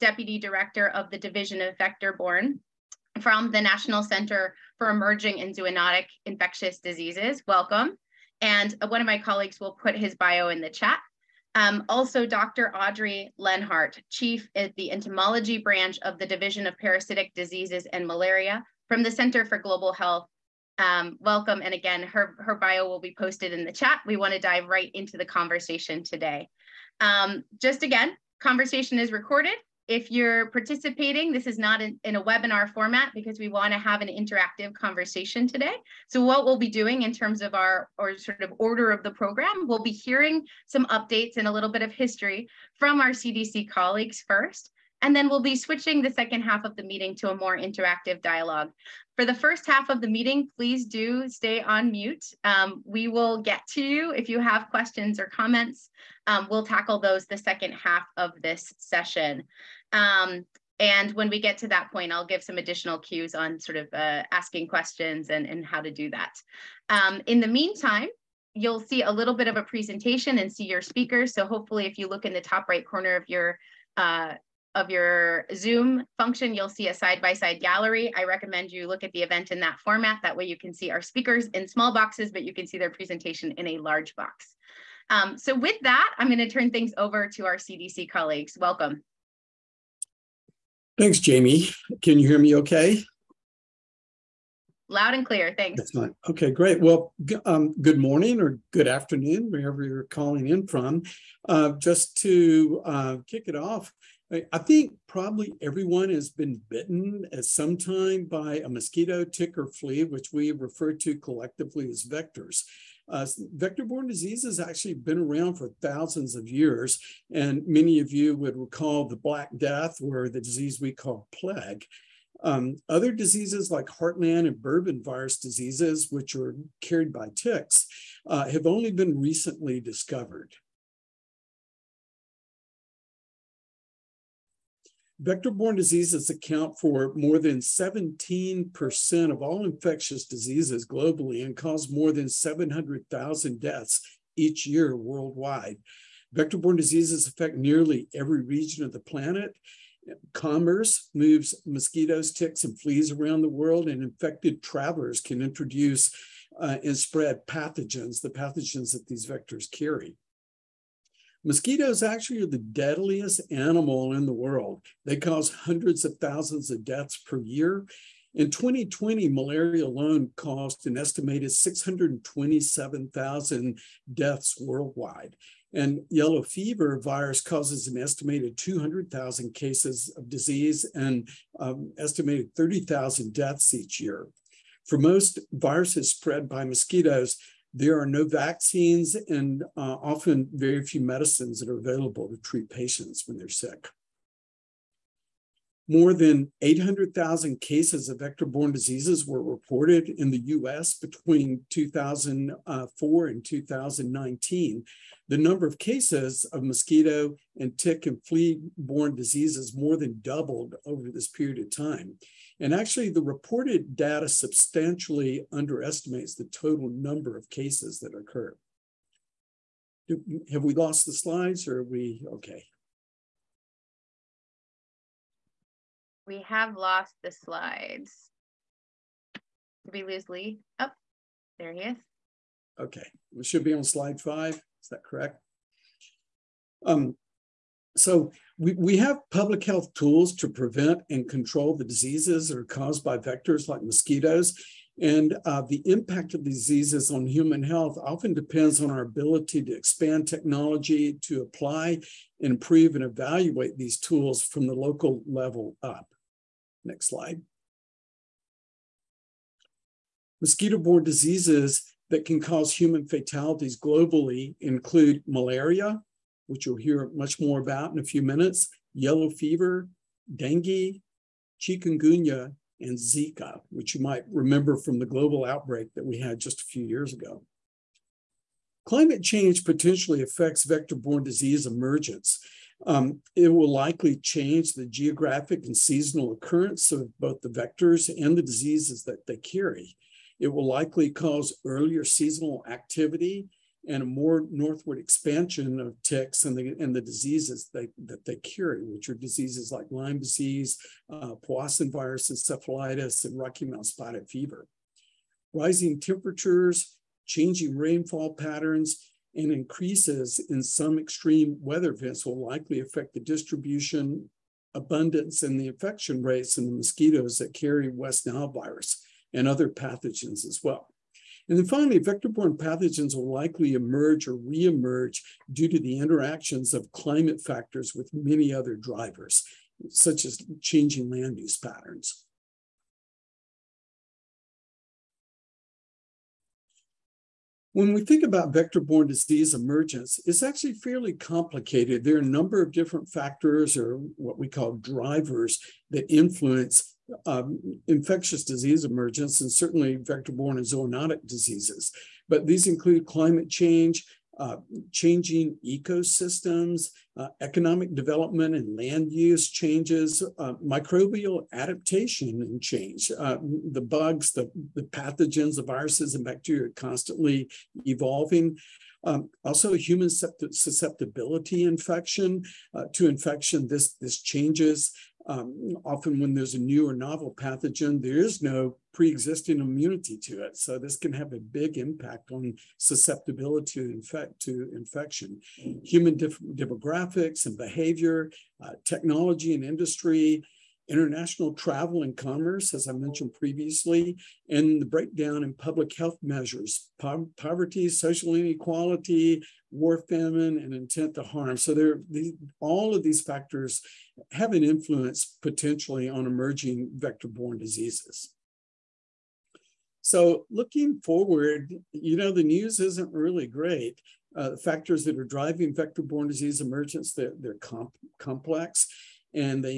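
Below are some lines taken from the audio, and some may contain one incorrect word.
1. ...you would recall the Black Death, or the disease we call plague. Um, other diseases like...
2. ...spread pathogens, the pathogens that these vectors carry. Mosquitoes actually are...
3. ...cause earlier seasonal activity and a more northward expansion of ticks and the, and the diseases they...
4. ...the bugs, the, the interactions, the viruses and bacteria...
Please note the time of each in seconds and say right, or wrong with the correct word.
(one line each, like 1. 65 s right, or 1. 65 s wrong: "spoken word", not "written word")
1. 118 s right
2. 156 s right
3. 291 s right
4. 363 s wrong: "pathogens", not "interactions".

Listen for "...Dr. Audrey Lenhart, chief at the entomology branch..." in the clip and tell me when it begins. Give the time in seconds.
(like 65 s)
12 s.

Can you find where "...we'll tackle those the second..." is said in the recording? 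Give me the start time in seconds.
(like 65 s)
56 s.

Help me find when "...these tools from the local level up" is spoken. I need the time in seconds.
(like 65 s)
253 s.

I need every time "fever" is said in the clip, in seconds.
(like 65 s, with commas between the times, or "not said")
176 s, 269 s, 304 s.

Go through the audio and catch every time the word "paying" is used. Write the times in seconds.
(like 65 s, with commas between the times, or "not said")
not said.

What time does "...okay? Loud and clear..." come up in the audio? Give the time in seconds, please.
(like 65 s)
92 s.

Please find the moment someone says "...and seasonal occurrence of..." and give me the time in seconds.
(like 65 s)
285 s.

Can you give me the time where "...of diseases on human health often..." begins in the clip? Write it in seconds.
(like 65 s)
246 s.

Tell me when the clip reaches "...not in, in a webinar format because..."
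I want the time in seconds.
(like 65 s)
31 s.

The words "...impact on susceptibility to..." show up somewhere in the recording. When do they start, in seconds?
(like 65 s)
381 s.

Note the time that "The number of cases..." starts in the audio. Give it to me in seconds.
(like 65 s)
205 s.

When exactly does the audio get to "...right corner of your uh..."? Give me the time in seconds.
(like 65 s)
72 s.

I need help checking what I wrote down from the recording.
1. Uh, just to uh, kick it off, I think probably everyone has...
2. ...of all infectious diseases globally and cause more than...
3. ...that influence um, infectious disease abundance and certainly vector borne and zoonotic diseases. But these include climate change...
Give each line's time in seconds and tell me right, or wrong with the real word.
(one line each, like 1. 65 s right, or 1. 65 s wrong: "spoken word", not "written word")
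1. 101 s right
2. 139 s right
3. 345 s wrong: "emergence", not "abundance".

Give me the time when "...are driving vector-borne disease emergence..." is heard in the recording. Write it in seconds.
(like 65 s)
415 s.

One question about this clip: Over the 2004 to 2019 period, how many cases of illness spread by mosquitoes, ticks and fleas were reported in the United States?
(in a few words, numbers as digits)
more than 800,000.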